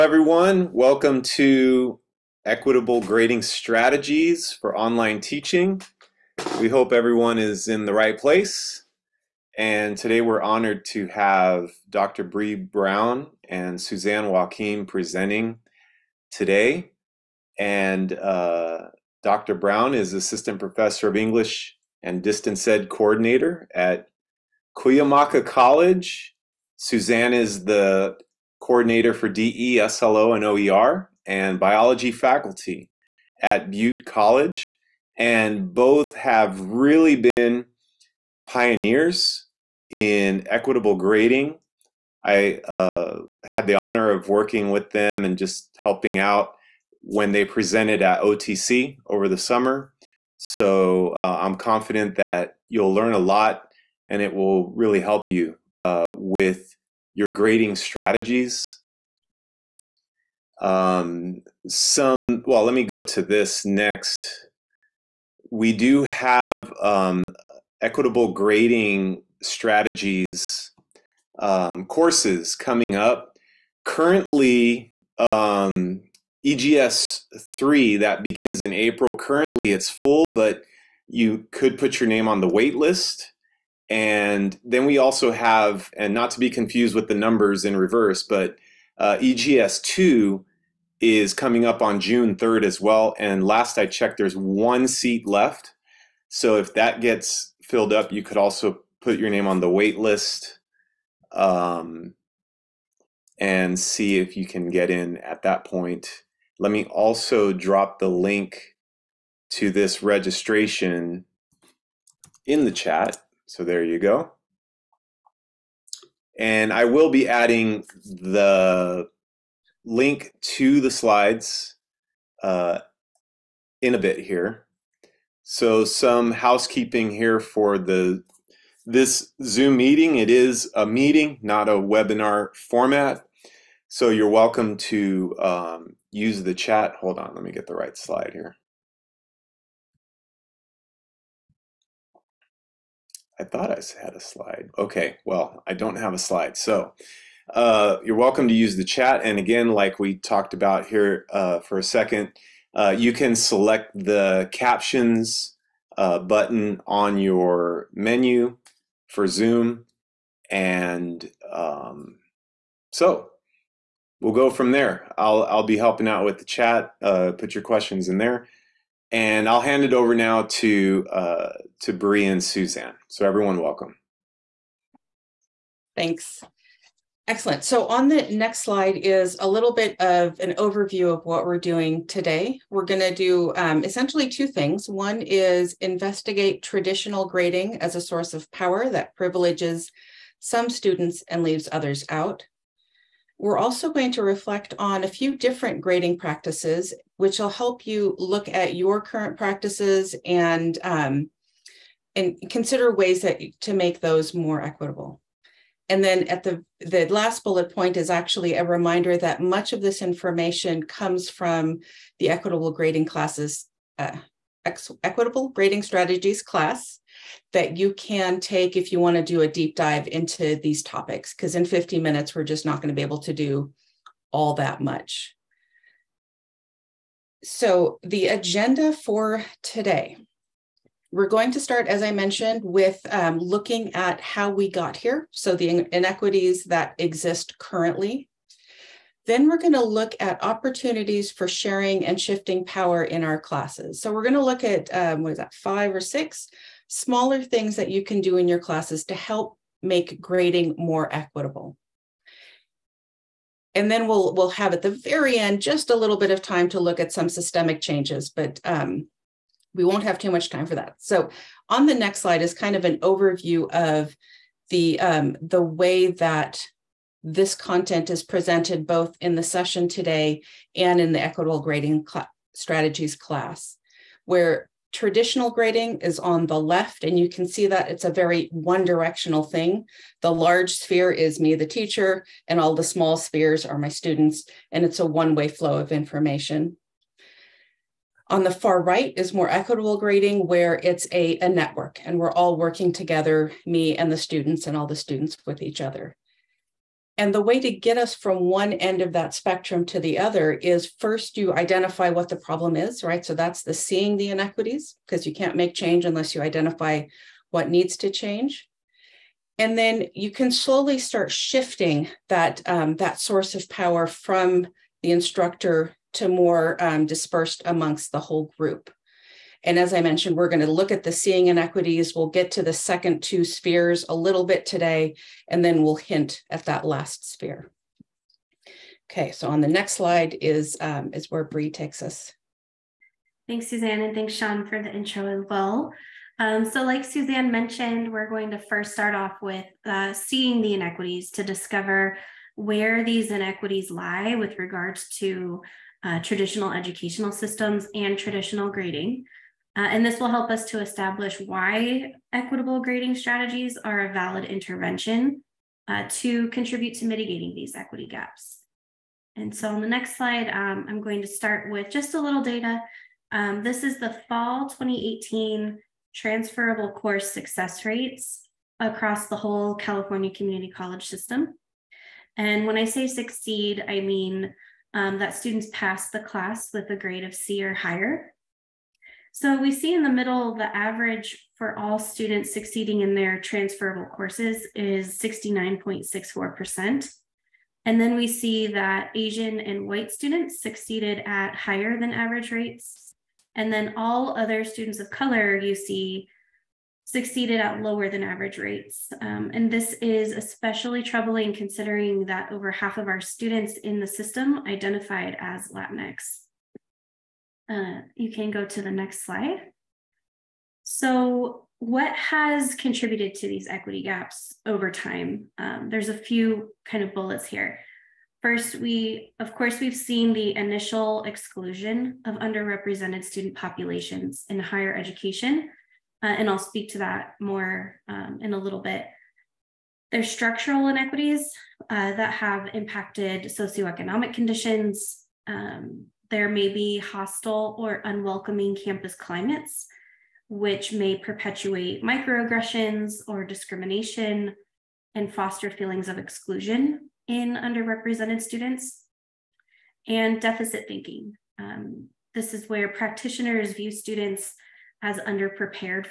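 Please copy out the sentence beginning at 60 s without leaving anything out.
Um, some, well, let me go to this next.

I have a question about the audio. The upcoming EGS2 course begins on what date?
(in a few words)
June 3rd.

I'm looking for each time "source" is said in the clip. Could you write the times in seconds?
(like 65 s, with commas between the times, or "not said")
188 s, 313 s.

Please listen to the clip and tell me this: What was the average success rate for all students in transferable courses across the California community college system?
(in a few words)
69.64%.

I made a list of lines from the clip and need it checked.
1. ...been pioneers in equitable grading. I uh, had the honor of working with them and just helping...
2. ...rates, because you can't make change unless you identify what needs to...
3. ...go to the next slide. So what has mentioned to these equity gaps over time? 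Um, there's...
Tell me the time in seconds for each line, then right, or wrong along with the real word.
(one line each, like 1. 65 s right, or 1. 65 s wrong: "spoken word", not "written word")
1. 37 s right
2. 304 s wrong: "inequities", not "rates"
3. 408 s wrong: "contributed", not "mentioned".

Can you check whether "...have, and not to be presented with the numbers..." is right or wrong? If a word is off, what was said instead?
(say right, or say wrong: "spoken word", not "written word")
wrong: "confused", not "presented".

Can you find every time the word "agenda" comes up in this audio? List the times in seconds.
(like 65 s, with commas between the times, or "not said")
228 s.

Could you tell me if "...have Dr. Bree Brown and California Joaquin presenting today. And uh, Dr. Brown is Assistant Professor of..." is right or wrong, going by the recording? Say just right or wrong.
wrong.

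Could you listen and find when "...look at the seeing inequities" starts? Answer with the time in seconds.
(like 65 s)
320 s.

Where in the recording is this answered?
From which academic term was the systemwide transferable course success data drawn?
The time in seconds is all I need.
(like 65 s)
364 s.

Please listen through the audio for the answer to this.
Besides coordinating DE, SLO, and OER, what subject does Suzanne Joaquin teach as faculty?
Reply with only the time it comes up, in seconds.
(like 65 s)
31 s.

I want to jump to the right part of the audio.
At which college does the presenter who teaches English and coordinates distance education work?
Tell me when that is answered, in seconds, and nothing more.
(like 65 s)
24 s.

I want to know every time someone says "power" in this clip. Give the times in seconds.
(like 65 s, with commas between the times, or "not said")
188 s, 242 s, 313 s.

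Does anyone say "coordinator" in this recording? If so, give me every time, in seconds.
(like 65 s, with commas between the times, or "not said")
22 s, 28 s.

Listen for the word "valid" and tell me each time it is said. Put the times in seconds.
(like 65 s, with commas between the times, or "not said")
354 s.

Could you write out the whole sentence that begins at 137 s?
Hold on, let me get the right slide here.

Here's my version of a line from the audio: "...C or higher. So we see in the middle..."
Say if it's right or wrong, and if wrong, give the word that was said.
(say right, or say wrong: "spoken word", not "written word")
right.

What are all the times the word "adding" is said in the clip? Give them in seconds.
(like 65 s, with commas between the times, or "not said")
117 s.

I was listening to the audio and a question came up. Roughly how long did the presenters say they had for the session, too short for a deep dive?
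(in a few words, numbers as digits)
50 minutes.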